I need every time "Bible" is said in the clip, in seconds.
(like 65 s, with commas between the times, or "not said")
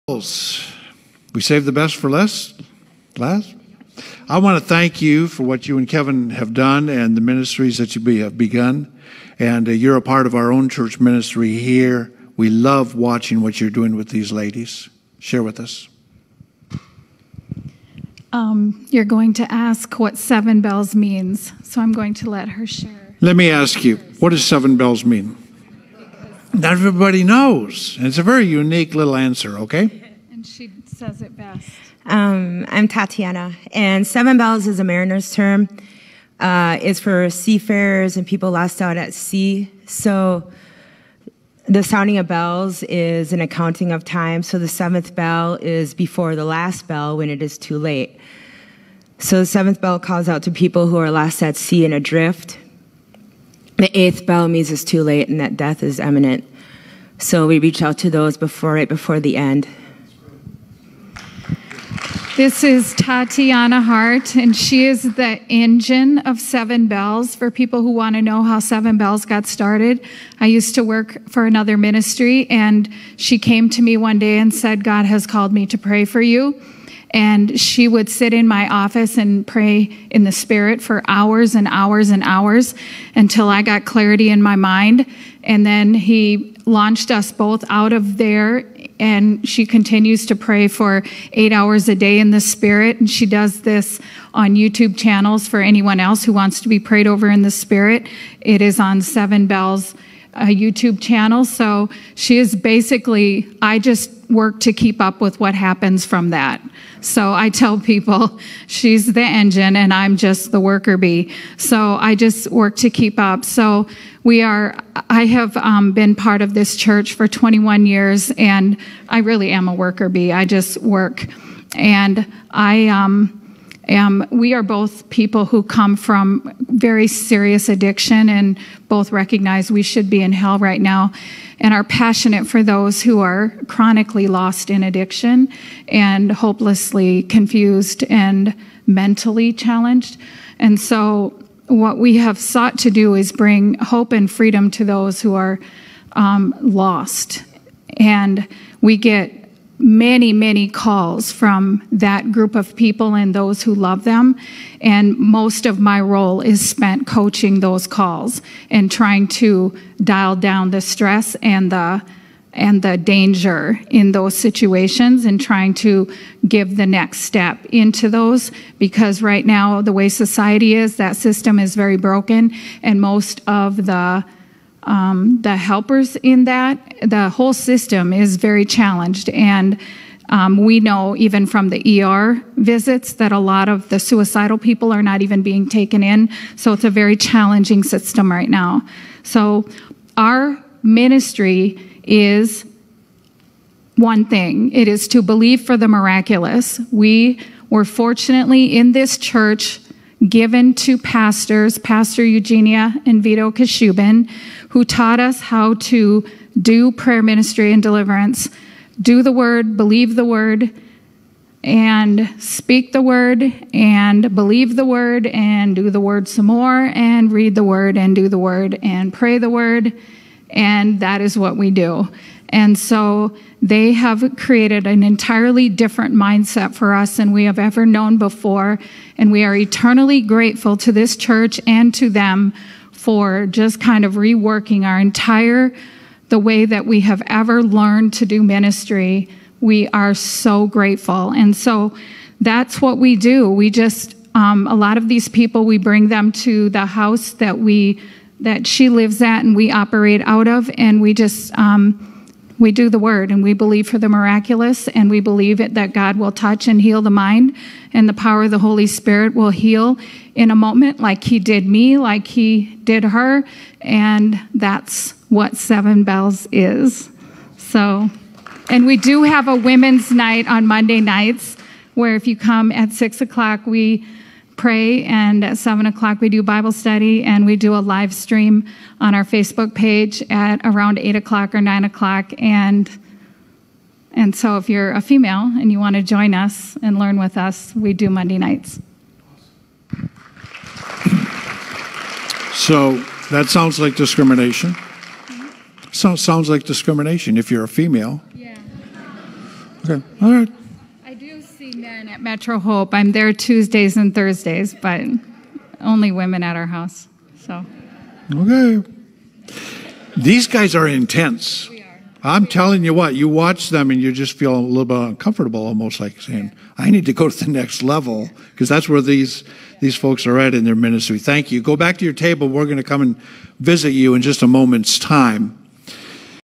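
276 s.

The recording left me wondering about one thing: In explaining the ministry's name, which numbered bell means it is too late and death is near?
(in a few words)
eighth bell.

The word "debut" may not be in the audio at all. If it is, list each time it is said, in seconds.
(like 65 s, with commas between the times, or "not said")
not said.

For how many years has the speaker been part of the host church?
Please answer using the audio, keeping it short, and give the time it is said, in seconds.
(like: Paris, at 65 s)
21, at 117 s.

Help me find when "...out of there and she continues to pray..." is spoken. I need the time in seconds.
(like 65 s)
87 s.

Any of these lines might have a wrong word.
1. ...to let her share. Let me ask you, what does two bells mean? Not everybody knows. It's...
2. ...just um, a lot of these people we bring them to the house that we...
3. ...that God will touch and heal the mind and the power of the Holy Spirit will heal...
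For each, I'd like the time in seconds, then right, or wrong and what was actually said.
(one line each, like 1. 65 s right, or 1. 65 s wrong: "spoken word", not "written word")
1. 22 s wrong: "seven", not "two"
2. 243 s right
3. 255 s right.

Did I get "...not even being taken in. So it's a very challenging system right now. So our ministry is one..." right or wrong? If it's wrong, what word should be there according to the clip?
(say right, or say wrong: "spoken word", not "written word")
right.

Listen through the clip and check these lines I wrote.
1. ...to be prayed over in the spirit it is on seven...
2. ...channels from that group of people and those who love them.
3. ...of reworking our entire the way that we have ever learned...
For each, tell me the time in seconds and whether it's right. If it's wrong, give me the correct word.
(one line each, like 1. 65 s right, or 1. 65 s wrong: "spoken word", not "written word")
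1. 96 s right
2. 150 s wrong: "calls", not "channels"
3. 234 s right.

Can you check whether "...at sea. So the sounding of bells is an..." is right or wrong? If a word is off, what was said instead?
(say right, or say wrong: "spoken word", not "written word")
right.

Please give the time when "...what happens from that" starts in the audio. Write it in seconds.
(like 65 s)
105 s.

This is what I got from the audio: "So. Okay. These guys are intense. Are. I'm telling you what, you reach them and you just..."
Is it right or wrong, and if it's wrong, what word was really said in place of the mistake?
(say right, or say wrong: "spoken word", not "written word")
wrong: "watch", not "reach".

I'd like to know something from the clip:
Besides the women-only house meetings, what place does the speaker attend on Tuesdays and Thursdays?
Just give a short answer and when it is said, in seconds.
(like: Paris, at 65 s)
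Metro Hope, at 302 s.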